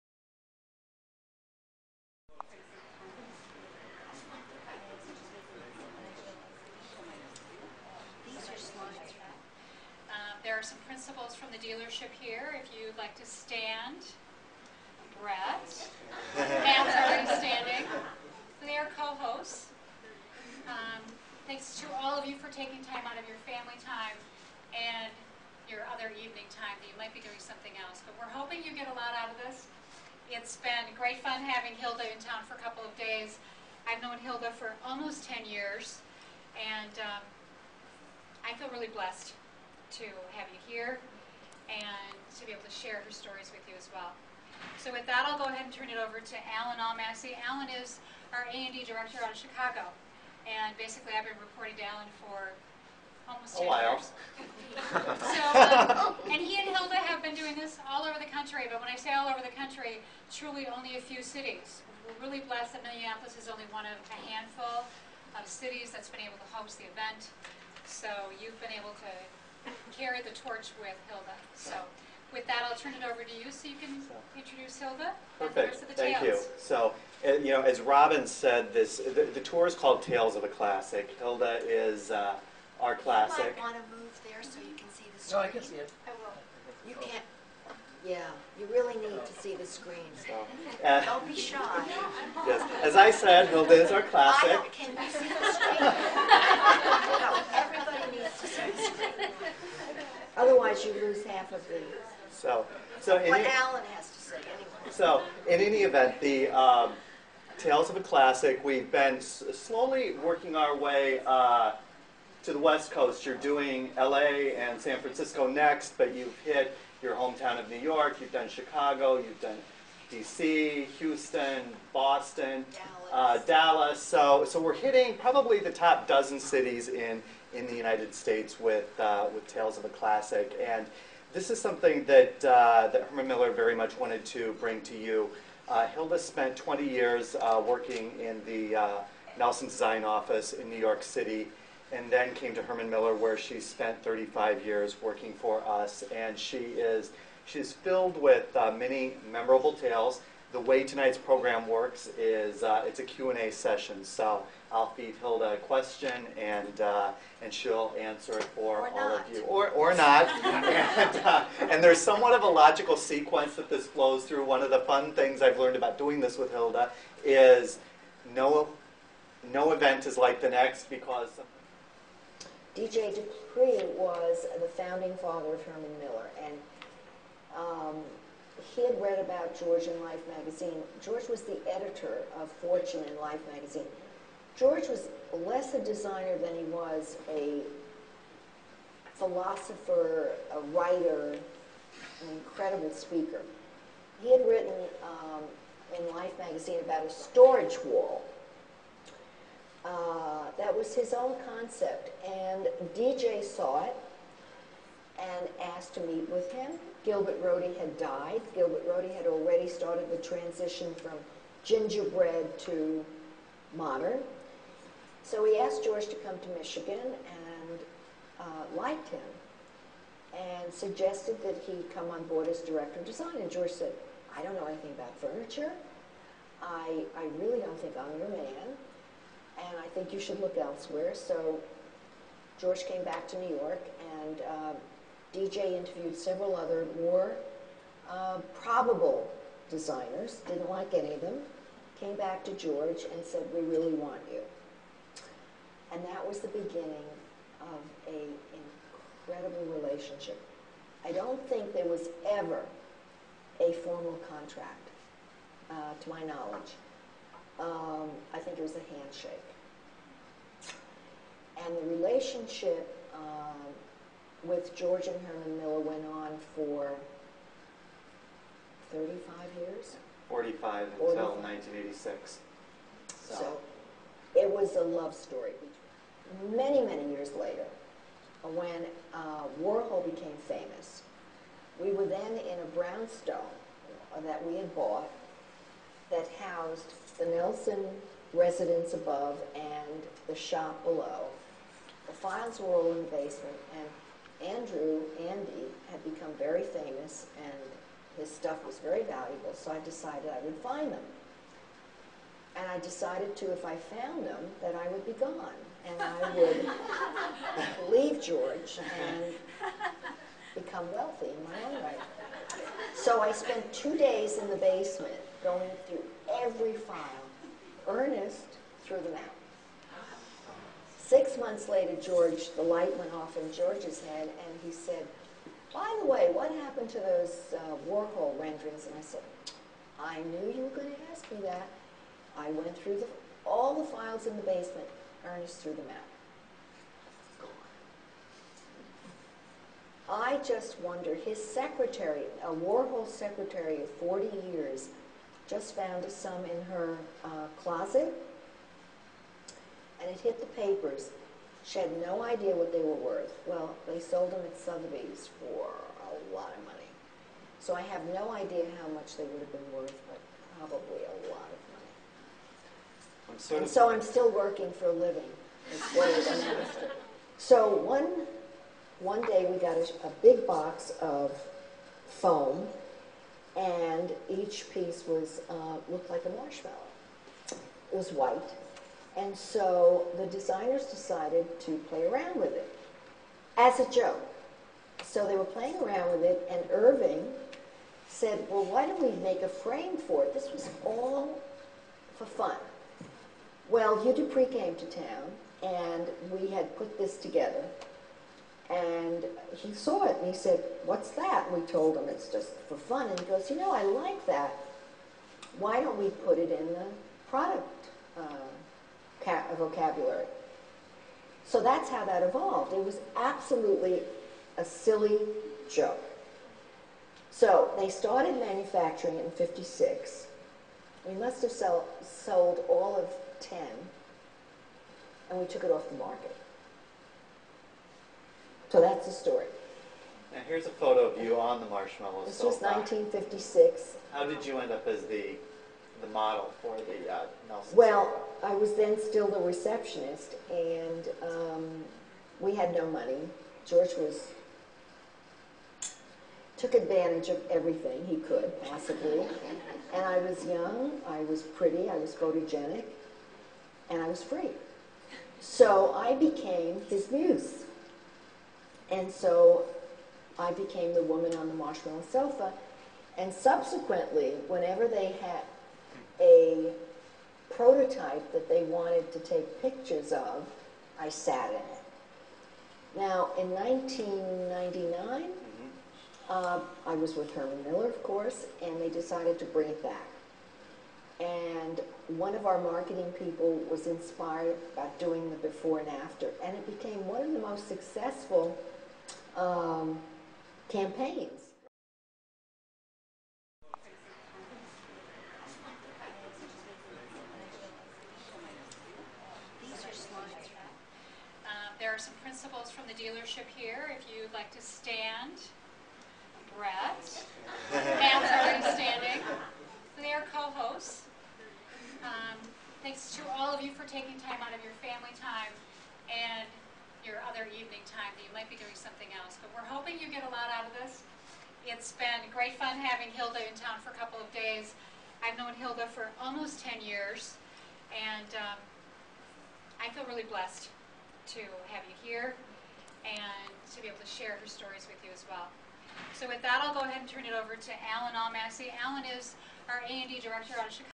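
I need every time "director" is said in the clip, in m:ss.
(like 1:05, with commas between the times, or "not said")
0:48, 3:42, 9:00.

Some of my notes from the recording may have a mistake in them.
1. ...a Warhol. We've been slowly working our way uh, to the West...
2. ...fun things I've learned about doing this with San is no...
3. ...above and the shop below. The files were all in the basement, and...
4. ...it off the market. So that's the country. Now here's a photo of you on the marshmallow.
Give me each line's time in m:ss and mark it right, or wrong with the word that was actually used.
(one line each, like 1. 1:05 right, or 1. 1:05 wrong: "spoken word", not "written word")
1. 1:47 wrong: "Classic", not "Warhol"
2. 2:44 wrong: "Hilda", not "San"
3. 4:48 right
4. 7:05 wrong: "story", not "country".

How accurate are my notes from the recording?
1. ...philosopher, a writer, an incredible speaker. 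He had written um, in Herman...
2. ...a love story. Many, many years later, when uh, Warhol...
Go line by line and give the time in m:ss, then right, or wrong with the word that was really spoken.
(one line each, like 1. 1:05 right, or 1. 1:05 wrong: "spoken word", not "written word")
1. 3:09 wrong: "Life", not "Herman"
2. 4:34 right.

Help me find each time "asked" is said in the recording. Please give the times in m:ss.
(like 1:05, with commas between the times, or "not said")
3:25, 3:35.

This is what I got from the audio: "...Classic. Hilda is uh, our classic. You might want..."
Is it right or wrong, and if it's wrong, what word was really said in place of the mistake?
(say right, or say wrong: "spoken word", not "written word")
right.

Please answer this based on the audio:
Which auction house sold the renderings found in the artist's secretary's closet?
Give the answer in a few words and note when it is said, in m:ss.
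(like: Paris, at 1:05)
Sotheby's, at 5:54.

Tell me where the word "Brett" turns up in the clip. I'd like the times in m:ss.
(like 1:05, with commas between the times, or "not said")
0:15, 8:26.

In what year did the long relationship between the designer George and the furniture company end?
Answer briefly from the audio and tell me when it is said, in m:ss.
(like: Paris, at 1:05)
1986, at 4:31.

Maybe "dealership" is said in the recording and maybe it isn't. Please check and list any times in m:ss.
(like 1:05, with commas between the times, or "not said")
0:11, 8:22.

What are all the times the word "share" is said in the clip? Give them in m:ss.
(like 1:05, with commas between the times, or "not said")
0:42, 8:54.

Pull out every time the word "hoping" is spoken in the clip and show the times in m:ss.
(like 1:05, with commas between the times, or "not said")
0:28, 8:39.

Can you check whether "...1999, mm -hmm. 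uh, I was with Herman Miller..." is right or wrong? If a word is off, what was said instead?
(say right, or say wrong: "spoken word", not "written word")
right.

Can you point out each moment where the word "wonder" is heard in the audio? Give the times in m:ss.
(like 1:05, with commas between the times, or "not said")
5:40.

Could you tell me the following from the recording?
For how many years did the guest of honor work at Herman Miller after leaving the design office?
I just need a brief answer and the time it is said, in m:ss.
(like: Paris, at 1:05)
35, at 2:24.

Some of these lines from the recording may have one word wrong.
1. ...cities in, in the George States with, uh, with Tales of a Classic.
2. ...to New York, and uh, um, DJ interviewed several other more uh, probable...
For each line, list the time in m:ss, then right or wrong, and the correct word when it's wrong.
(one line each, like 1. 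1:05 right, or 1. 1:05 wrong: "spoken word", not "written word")
1. 2:06 wrong: "United", not "George"
2. 3:53 right.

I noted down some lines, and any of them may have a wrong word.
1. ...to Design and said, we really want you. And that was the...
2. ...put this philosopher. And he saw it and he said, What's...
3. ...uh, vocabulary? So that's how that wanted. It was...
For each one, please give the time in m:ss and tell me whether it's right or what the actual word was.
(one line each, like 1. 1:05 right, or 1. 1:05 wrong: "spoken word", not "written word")
1. 4:02 wrong: "George", not "Design"
2. 6:36 wrong: "together", not "philosopher"
3. 6:48 wrong: "evolved", not "wanted".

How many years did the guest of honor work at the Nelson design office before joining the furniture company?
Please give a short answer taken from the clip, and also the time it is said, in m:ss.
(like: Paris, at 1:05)
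20, at 2:16.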